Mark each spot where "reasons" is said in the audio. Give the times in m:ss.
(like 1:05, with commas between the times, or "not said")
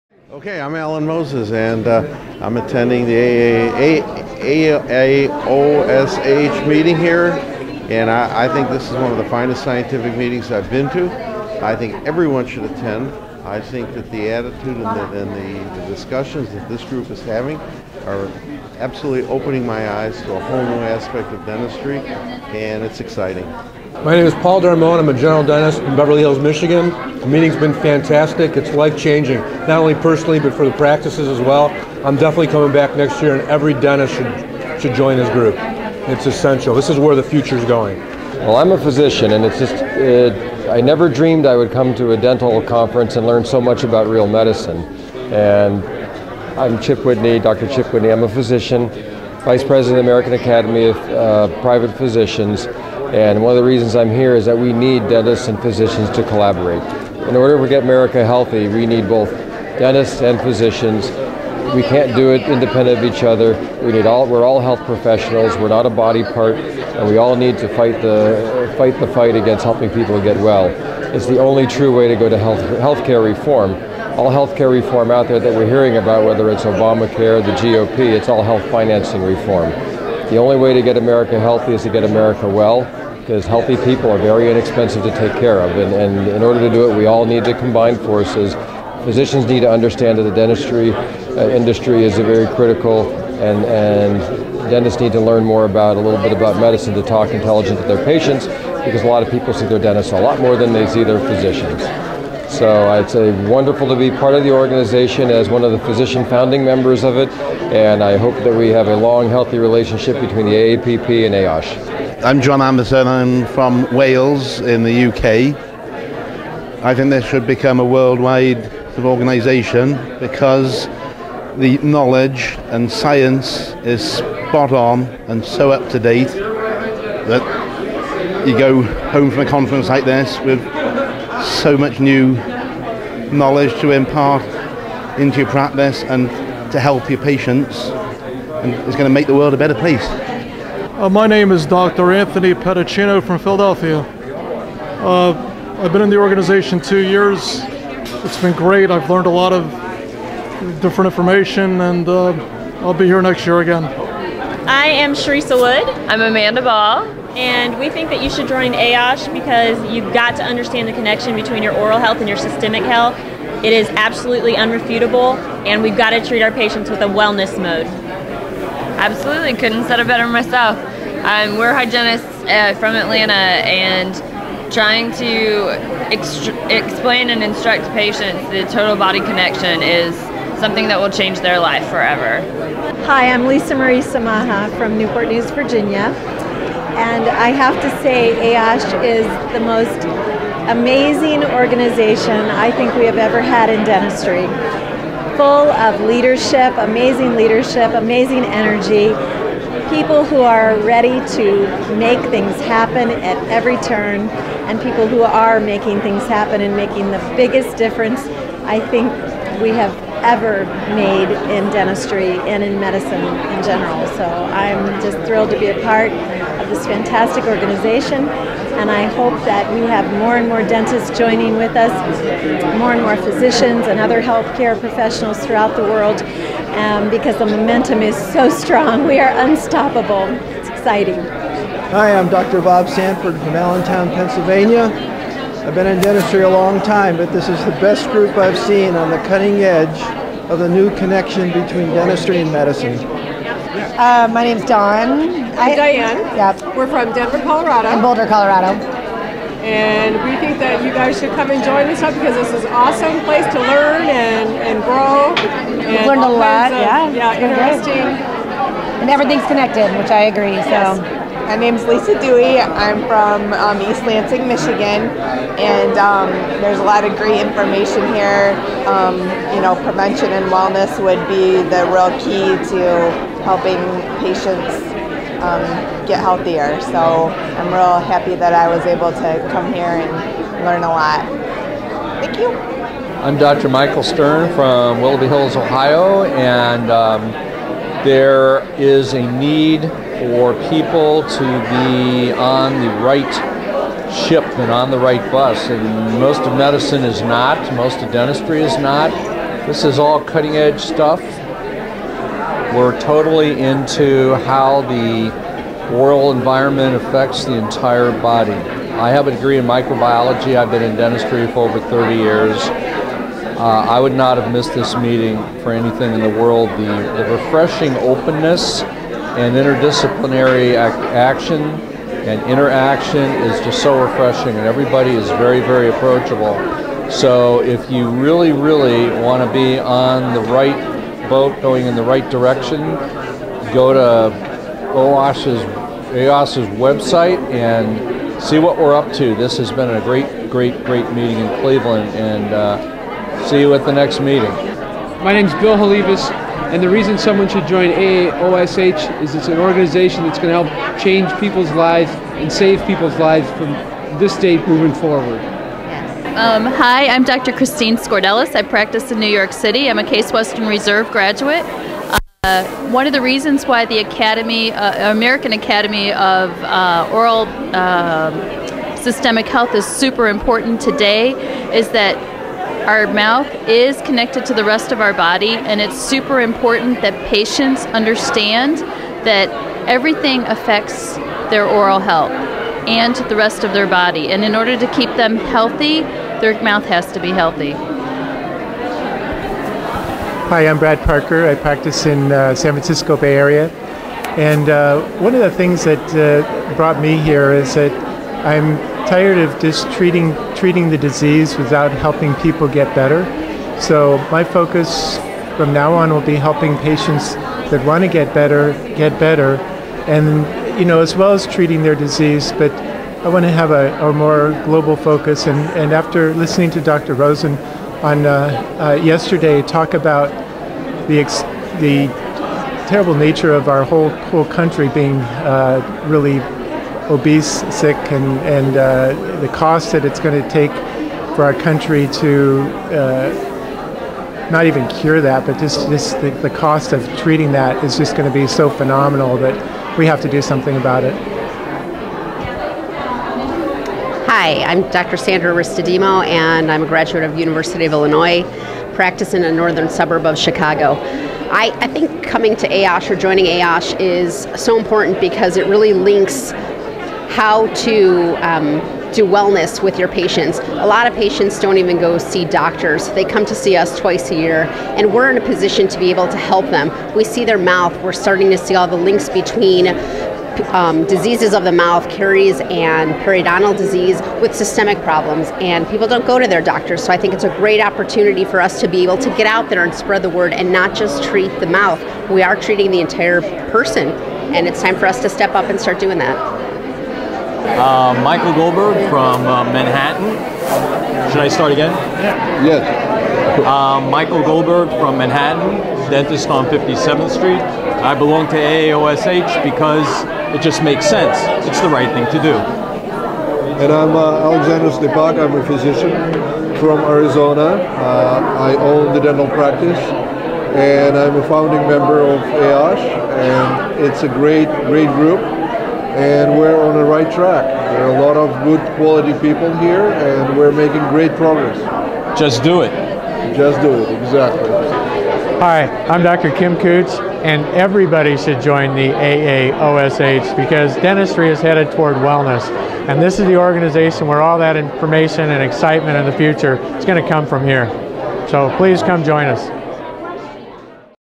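0:53, 5:46, 6:03.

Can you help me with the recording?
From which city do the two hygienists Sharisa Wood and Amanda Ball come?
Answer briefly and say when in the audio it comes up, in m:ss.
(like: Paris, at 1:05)
Atlanta, at 2:52.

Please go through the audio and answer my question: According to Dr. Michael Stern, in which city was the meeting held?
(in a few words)
Cleveland.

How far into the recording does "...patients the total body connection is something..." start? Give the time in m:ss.
2:57.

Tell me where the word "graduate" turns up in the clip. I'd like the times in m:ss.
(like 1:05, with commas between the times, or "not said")
6:01, 7:26.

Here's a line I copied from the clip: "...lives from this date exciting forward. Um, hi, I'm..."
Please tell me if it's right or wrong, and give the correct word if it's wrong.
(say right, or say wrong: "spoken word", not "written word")
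wrong: "moving", not "exciting".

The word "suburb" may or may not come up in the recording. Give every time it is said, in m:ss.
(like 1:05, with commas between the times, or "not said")
7:29.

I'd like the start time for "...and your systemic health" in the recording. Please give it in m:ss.
2:42.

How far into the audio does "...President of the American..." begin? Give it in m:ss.
0:49.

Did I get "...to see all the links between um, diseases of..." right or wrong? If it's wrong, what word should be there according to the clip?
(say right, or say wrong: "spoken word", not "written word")
right.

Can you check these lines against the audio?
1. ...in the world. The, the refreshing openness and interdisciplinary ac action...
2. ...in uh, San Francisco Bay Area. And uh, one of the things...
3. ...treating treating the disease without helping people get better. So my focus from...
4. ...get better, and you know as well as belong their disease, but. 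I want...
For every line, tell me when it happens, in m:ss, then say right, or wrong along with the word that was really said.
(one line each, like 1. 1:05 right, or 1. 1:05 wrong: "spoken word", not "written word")
1. 5:16 right
2. 6:32 right
3. 6:39 right
4. 6:48 wrong: "treating", not "belong".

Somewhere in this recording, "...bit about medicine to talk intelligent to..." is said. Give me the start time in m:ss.
1:36.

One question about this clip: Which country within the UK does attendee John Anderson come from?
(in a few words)
Wales.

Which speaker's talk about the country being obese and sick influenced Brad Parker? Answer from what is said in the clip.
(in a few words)
Dr. Rosen.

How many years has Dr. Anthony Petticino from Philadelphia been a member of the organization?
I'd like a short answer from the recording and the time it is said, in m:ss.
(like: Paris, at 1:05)
2, at 2:26.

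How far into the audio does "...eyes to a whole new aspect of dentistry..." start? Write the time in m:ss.
0:19.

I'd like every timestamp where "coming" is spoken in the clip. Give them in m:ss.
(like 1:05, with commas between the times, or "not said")
0:32, 7:32.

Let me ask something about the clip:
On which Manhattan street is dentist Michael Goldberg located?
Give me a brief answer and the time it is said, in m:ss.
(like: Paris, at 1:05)
57th Street, at 8:16.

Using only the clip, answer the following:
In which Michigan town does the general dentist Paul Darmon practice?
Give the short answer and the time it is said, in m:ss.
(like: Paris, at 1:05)
Beverly Hills, at 0:25.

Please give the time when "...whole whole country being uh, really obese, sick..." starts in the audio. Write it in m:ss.
7:03.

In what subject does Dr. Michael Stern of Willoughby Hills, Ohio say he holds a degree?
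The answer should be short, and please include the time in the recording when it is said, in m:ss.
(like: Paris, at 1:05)
Microbiology, at 5:09.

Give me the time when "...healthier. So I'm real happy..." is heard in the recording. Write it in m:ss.
4:36.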